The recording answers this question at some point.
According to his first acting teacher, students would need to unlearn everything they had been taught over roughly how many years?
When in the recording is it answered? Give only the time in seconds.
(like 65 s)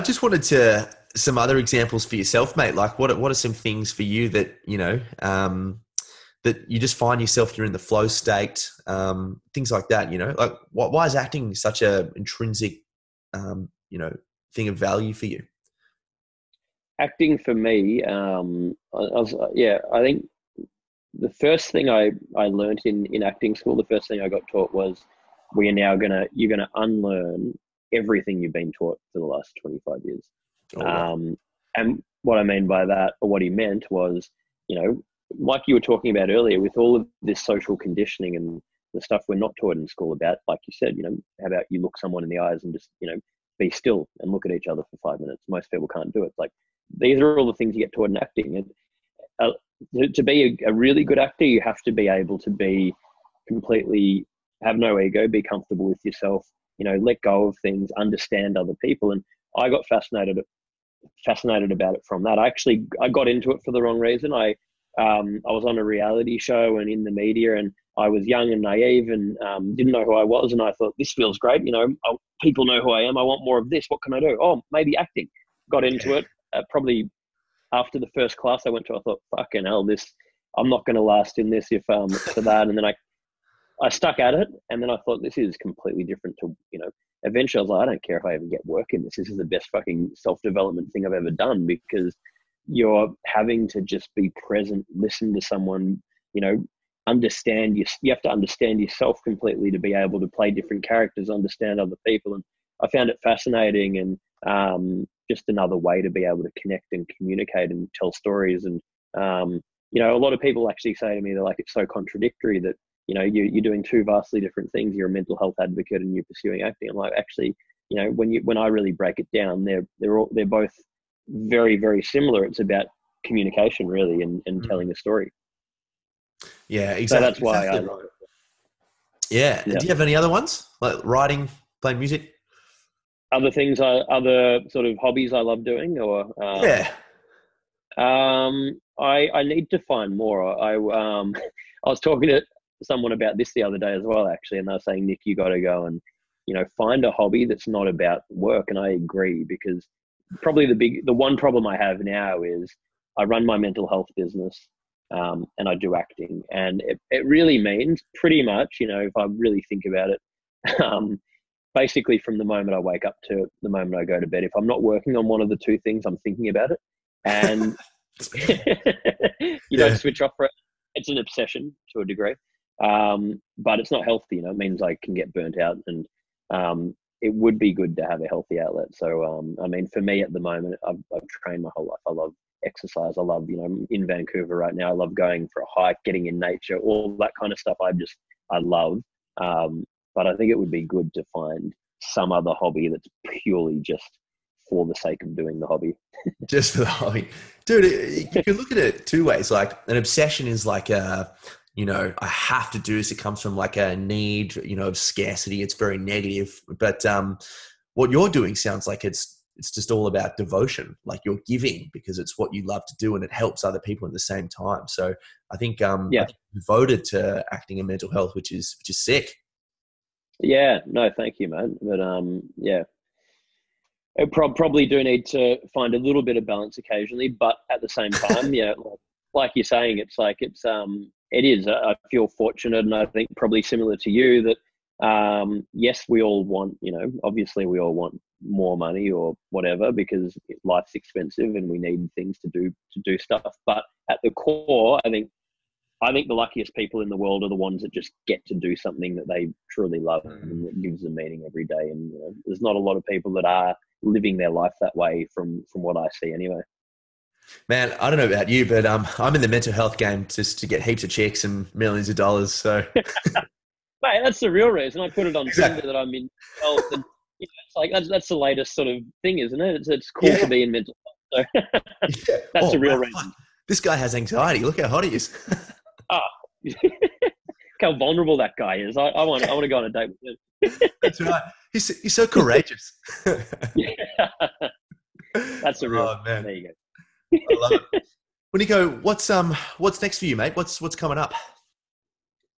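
29 s.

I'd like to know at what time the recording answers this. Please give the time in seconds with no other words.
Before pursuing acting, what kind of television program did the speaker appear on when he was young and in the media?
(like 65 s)
65 s.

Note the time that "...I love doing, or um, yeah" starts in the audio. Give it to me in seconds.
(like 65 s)
135 s.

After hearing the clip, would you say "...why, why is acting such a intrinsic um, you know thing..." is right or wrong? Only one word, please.
right.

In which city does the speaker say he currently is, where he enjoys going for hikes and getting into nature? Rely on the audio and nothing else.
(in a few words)
Vancouver.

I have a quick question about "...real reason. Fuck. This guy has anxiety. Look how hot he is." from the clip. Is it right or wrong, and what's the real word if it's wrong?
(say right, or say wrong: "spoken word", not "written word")
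right.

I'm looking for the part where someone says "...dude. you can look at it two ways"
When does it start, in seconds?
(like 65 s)
197 s.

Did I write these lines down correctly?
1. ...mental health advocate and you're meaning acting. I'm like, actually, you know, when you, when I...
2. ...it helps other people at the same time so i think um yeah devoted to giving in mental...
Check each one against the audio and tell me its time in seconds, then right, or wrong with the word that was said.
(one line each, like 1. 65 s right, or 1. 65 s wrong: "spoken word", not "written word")
1. 115 s wrong: "pursuing", not "meaning"
2. 213 s wrong: "acting", not "giving".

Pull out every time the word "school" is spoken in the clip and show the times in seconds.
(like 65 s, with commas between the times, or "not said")
23 s, 39 s.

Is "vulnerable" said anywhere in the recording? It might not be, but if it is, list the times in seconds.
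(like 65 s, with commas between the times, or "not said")
277 s.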